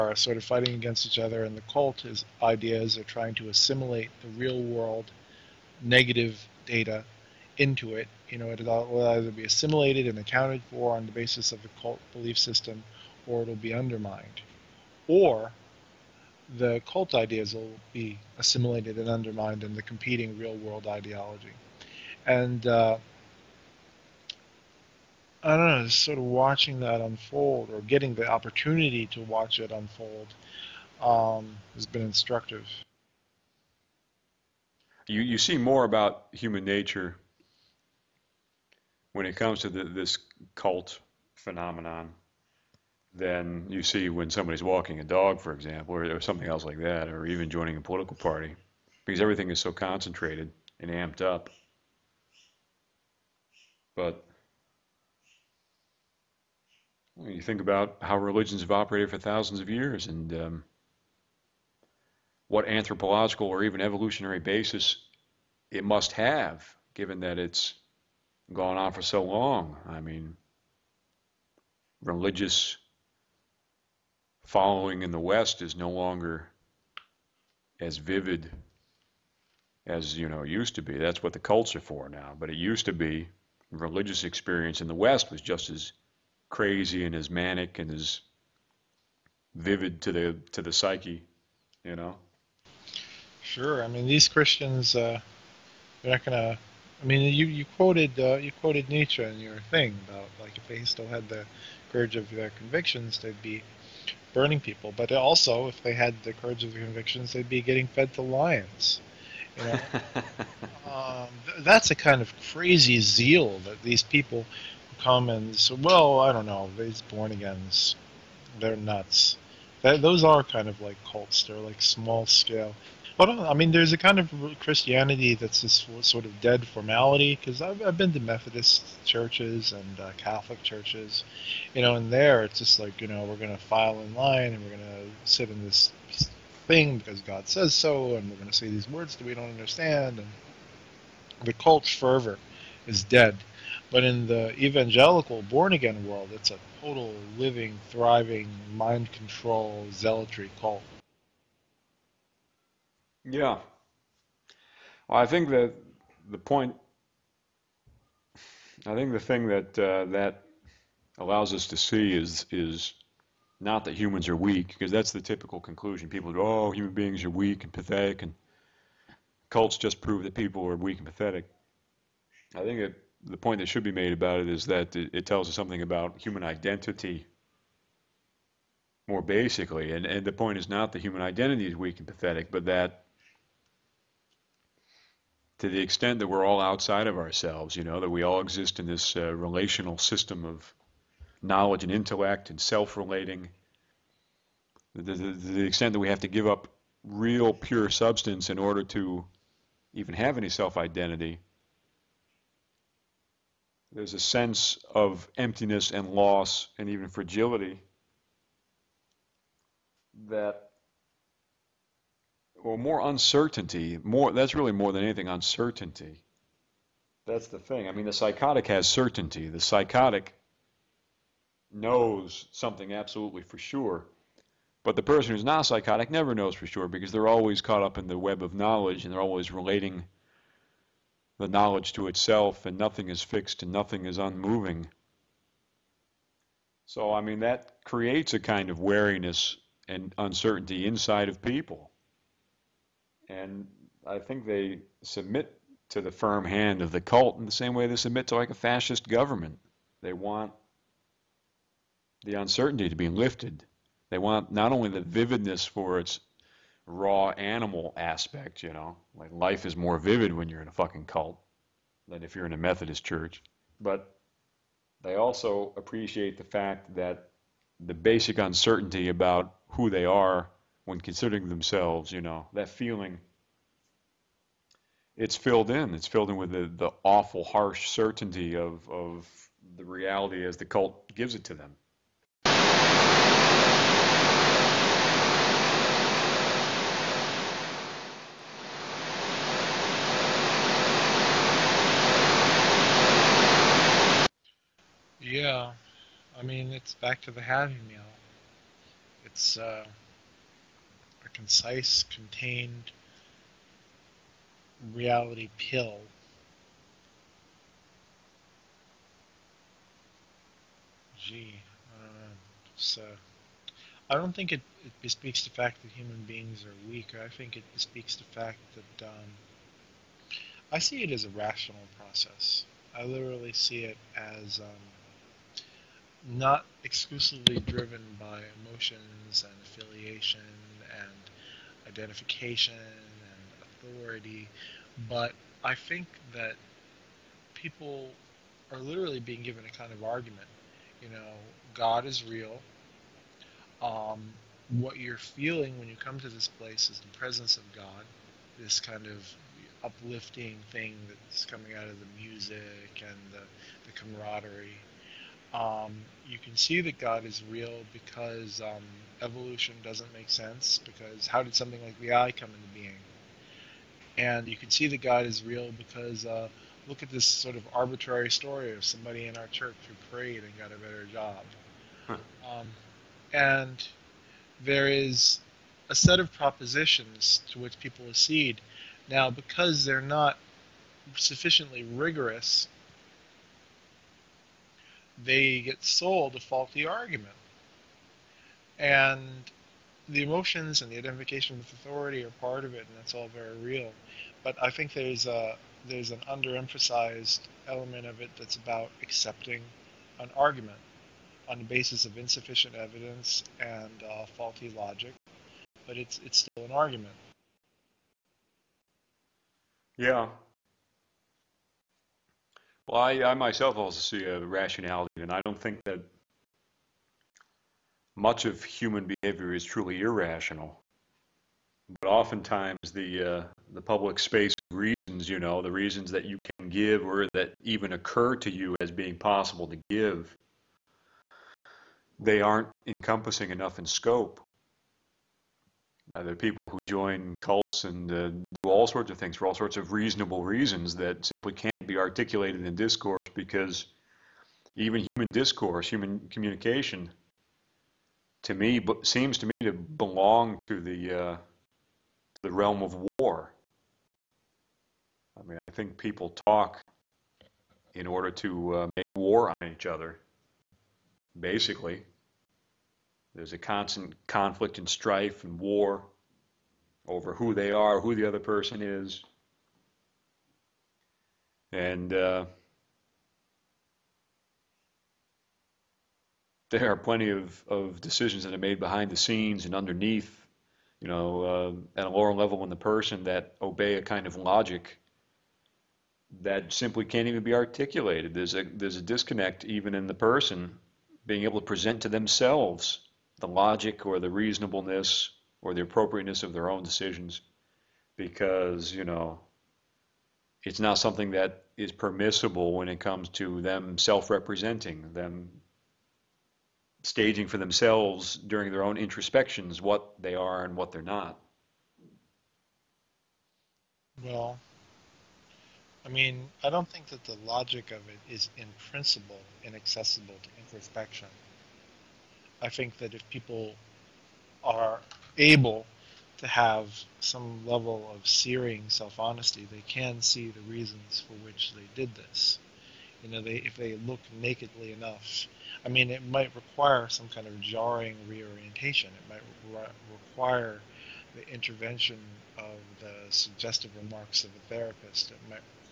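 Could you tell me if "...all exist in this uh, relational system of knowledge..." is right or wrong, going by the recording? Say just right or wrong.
right.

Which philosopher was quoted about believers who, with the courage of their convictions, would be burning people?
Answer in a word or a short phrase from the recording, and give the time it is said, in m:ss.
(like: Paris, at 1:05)
Nietzsche, at 1:38.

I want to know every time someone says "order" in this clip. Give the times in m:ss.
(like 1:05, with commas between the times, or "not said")
3:18, 7:38.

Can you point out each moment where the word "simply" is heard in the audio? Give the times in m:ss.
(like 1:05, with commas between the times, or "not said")
7:21, 8:06.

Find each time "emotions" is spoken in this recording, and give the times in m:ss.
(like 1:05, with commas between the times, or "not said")
5:28, 6:30.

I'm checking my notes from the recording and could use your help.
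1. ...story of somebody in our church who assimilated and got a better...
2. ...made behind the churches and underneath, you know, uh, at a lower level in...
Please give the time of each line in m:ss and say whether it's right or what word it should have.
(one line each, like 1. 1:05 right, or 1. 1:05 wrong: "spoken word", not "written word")
1. 6:08 wrong: "prayed", not "assimilated"
2. 7:58 wrong: "scenes", not "churches".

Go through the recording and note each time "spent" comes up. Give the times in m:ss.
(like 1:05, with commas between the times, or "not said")
not said.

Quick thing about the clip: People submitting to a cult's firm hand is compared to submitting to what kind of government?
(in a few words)
a fascist government.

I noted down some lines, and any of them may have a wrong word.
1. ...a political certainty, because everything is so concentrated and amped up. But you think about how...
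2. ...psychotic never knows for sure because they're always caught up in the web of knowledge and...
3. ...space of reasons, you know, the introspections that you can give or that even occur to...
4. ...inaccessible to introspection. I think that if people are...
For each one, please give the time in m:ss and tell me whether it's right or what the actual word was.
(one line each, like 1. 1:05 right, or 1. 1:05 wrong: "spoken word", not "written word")
1. 0:47 wrong: "party", not "certainty"
2. 3:45 right
3. 7:04 wrong: "reasons", not "introspections"
4. 8:39 right.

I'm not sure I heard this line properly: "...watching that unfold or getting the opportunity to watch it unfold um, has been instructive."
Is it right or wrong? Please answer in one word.
right.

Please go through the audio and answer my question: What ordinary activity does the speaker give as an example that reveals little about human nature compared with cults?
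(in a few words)
walking a dog.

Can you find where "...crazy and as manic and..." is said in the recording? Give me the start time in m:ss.
1:26.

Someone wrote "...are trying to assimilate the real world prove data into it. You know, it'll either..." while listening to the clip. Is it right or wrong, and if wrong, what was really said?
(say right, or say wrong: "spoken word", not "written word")
wrong: "negative", not "prove".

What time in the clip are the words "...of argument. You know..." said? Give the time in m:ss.
5:39.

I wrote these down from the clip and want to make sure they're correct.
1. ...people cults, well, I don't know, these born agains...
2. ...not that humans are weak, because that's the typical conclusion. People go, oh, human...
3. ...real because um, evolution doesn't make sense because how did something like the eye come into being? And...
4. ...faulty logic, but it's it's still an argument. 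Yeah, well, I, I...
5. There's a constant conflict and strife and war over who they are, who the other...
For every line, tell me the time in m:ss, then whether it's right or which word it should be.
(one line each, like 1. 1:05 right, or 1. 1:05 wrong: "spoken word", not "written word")
1. 1:54 wrong: "comments", not "cults"
2. 2:43 right
3. 5:57 right
4. 6:44 right
5. 7:43 right.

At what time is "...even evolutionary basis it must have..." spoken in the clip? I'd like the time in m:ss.
1:03.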